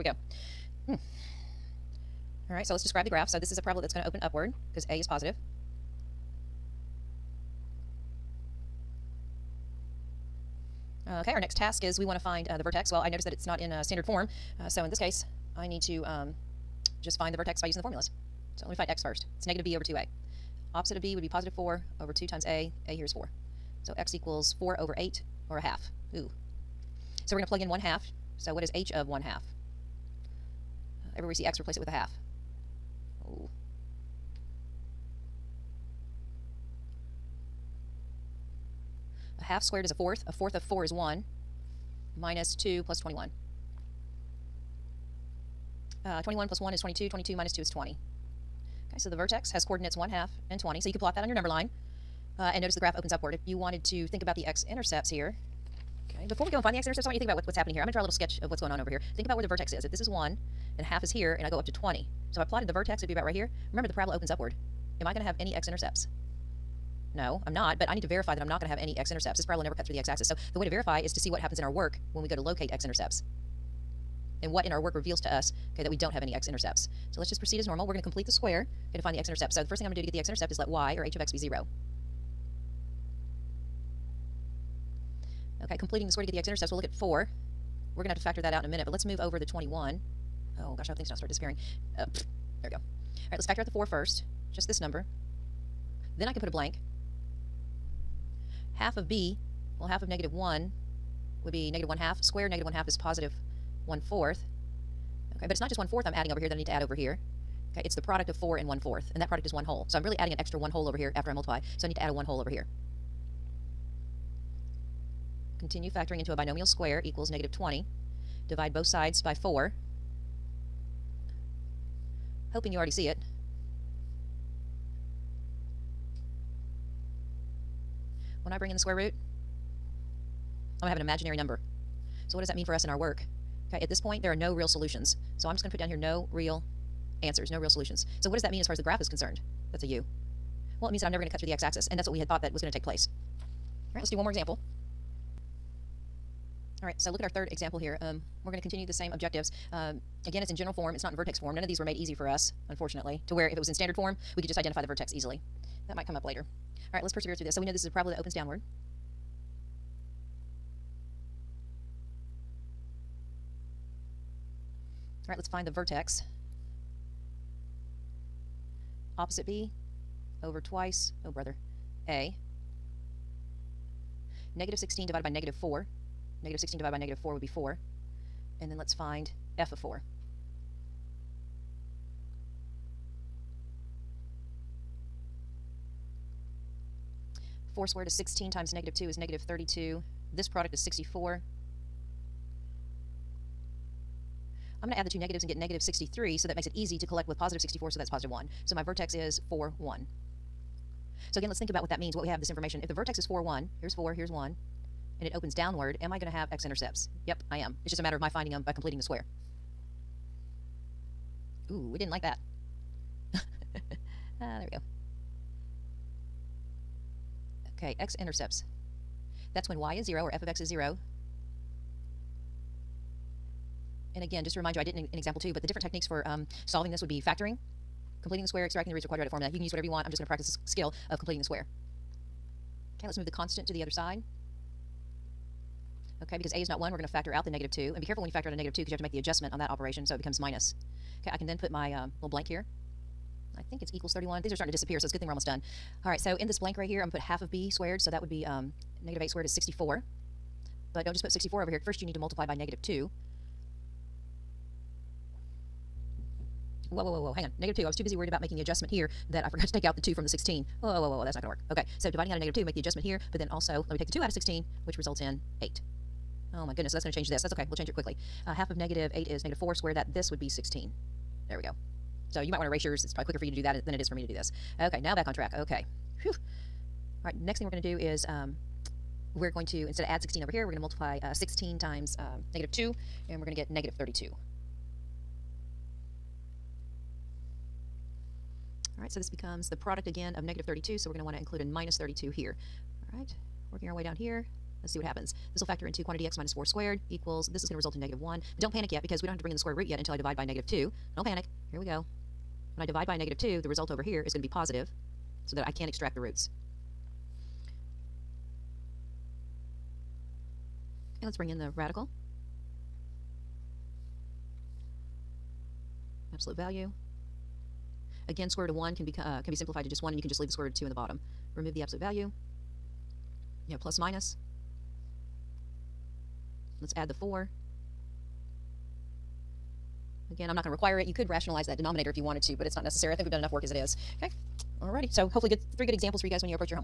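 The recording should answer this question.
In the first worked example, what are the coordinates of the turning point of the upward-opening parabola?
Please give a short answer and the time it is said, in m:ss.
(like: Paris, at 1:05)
(1/2, 20), at 0:49.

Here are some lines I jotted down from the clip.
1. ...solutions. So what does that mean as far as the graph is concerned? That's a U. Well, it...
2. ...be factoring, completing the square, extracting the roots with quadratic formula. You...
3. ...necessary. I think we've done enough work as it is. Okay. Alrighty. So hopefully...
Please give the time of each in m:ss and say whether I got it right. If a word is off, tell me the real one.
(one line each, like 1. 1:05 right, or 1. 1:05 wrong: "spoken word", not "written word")
1. 2:17 right
2. 3:47 right
3. 5:32 right.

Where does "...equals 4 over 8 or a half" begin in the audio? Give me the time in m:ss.
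0:24.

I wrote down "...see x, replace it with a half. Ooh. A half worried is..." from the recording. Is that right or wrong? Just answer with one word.
wrong.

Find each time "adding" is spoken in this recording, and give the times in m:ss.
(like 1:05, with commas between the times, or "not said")
1:46, 1:50.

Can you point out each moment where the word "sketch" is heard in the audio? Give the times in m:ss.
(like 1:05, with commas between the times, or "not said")
0:58.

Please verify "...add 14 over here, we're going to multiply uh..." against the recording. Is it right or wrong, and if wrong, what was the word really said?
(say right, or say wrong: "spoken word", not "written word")
wrong: "16", not "14".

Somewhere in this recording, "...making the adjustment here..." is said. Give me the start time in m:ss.
4:18.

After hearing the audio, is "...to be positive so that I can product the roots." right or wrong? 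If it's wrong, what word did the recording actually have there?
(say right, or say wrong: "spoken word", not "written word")
wrong: "extract", not "product".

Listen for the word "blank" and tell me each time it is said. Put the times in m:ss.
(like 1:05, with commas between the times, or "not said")
1:36, 4:02, 4:06.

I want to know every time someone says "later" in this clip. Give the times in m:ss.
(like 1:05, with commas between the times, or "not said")
2:36.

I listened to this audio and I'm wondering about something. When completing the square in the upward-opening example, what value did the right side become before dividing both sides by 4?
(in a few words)
-20.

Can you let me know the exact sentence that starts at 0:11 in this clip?
Okay, our next task is we want to find uh, the vertex.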